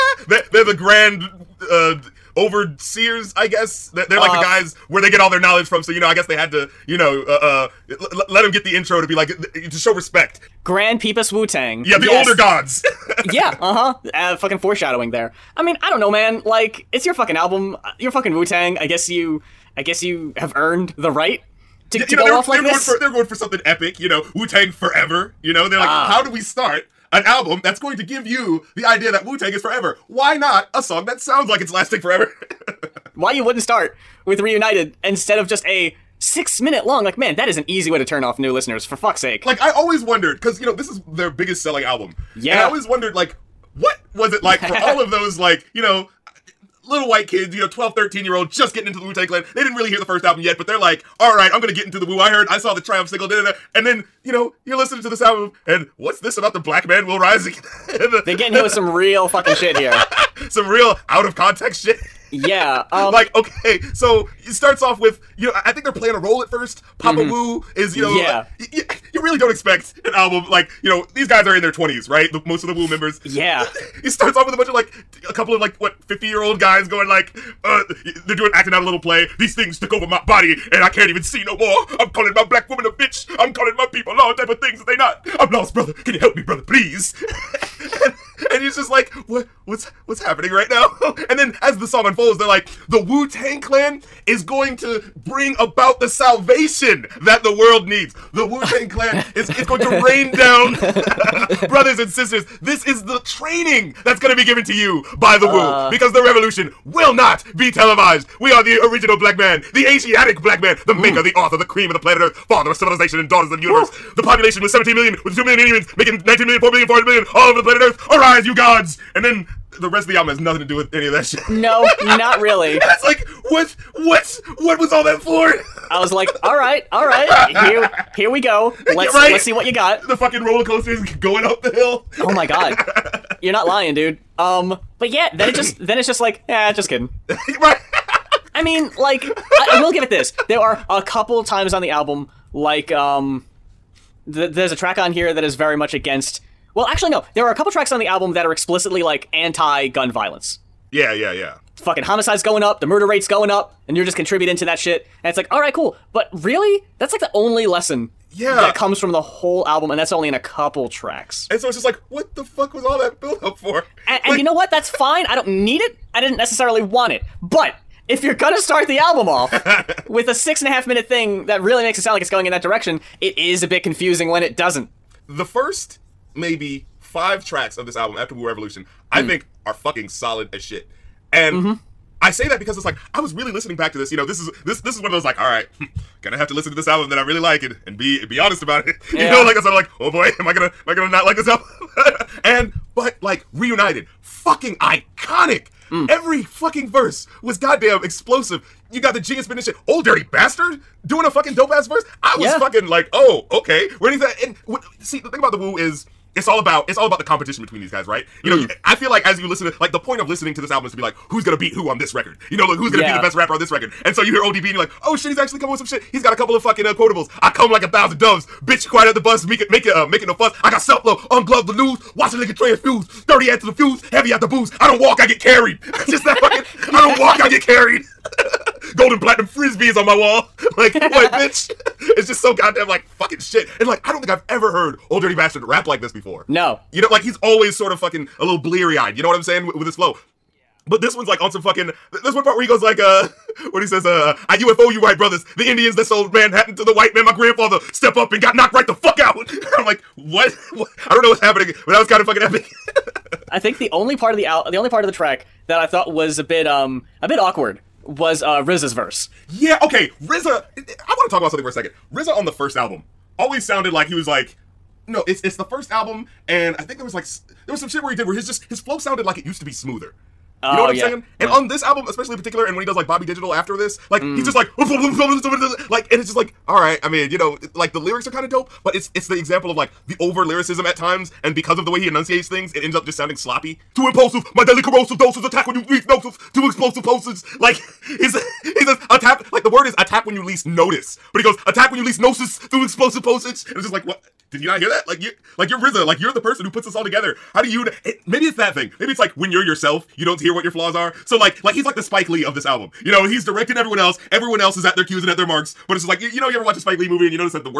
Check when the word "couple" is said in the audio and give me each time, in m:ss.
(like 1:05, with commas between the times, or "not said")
1:15, 2:21, 2:27, 2:40, 3:36.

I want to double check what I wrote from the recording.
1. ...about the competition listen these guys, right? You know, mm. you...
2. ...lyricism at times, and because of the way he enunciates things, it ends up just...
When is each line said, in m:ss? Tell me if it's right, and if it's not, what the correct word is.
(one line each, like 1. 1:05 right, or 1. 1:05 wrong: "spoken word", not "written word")
1. 3:27 wrong: "between", not "listen"
2. 4:40 right.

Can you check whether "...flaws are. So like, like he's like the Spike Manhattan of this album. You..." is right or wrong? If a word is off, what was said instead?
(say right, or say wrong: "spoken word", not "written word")
wrong: "Lee", not "Manhattan".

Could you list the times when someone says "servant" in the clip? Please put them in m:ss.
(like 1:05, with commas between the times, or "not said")
not said.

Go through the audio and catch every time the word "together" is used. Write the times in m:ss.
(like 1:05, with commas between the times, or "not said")
4:57.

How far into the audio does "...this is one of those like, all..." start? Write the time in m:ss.
3:04.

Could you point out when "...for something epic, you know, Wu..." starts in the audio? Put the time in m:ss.
0:23.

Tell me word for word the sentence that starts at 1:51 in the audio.
maker, the author, the cream of the planet Earth, father of civilization and daughters of the universe.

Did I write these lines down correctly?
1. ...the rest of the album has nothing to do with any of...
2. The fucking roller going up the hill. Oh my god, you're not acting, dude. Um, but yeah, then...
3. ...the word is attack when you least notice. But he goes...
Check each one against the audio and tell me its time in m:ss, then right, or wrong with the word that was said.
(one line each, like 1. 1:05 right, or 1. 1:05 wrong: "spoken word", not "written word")
1. 1:59 right
2. 2:10 wrong: "lying", not "acting"
3. 4:49 right.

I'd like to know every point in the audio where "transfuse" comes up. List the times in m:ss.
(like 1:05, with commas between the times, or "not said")
3:42.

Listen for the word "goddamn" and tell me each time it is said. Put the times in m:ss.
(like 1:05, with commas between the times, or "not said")
3:17, 3:52.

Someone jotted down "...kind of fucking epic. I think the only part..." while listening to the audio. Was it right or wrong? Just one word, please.
right.